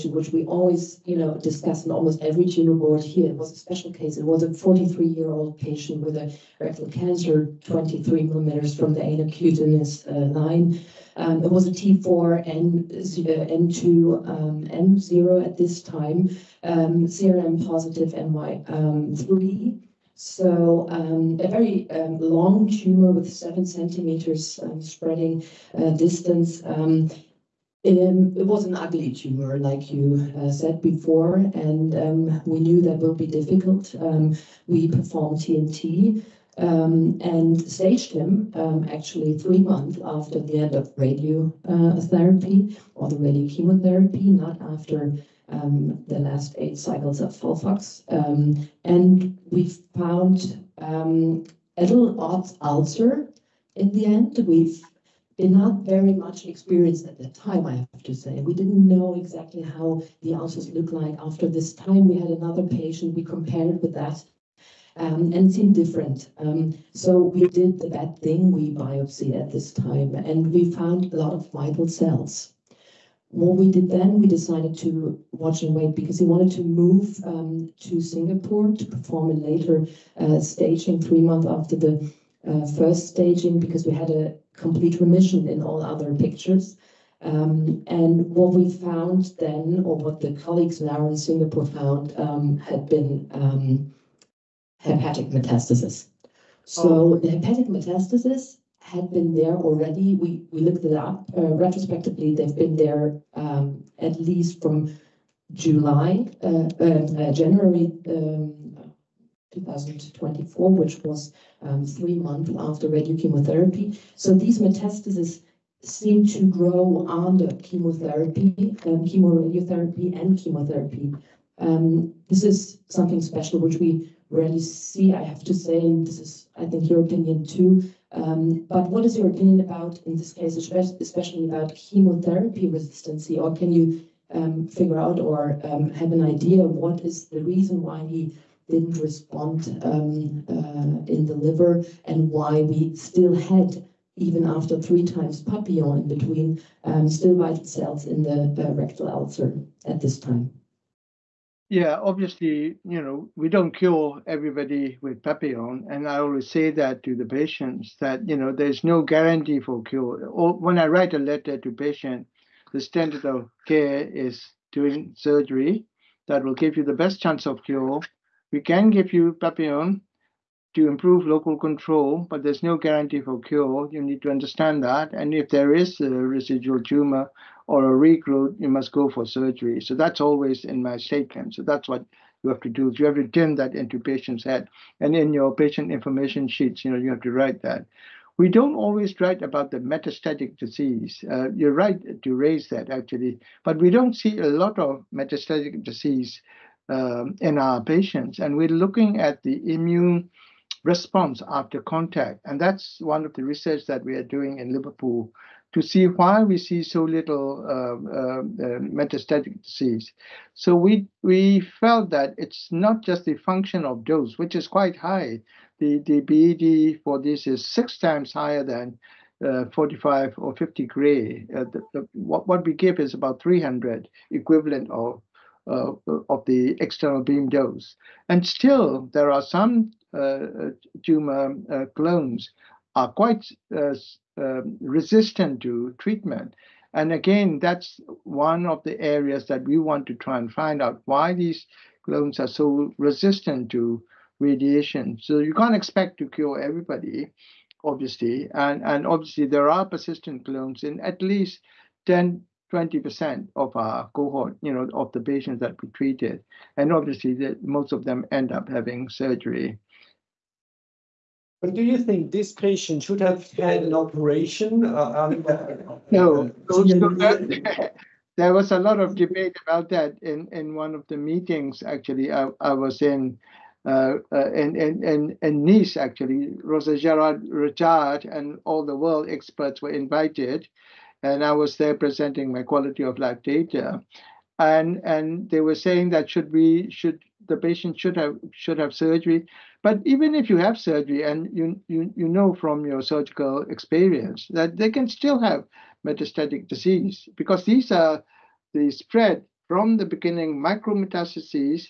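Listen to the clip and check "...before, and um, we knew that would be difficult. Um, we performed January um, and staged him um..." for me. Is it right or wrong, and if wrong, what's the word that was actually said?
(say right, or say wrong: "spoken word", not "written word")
wrong: "TNT", not "January".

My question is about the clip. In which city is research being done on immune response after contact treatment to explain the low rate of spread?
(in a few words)
Liverpool.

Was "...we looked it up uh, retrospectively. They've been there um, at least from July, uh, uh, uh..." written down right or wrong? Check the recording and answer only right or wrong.
right.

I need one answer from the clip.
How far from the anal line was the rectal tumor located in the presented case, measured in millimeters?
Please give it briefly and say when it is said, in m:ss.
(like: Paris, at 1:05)
23 millimeters, at 0:07.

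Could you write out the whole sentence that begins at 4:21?
But do you think this patient should have had an operation?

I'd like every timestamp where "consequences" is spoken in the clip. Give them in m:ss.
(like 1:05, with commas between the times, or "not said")
not said.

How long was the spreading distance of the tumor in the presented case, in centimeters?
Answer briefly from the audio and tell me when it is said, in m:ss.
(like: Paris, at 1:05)
7 centimeters, at 0:23.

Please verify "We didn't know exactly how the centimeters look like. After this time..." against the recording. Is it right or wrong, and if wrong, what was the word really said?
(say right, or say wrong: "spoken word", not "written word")
wrong: "ulcers", not "centimeters".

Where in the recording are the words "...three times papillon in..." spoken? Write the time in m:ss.
2:24.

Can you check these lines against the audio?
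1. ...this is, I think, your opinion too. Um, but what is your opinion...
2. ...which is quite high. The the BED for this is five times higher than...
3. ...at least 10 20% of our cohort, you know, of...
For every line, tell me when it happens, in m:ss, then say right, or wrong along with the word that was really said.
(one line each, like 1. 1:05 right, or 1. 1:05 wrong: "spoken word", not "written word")
1. 2:06 right
2. 3:34 wrong: "six", not "five"
3. 4:10 right.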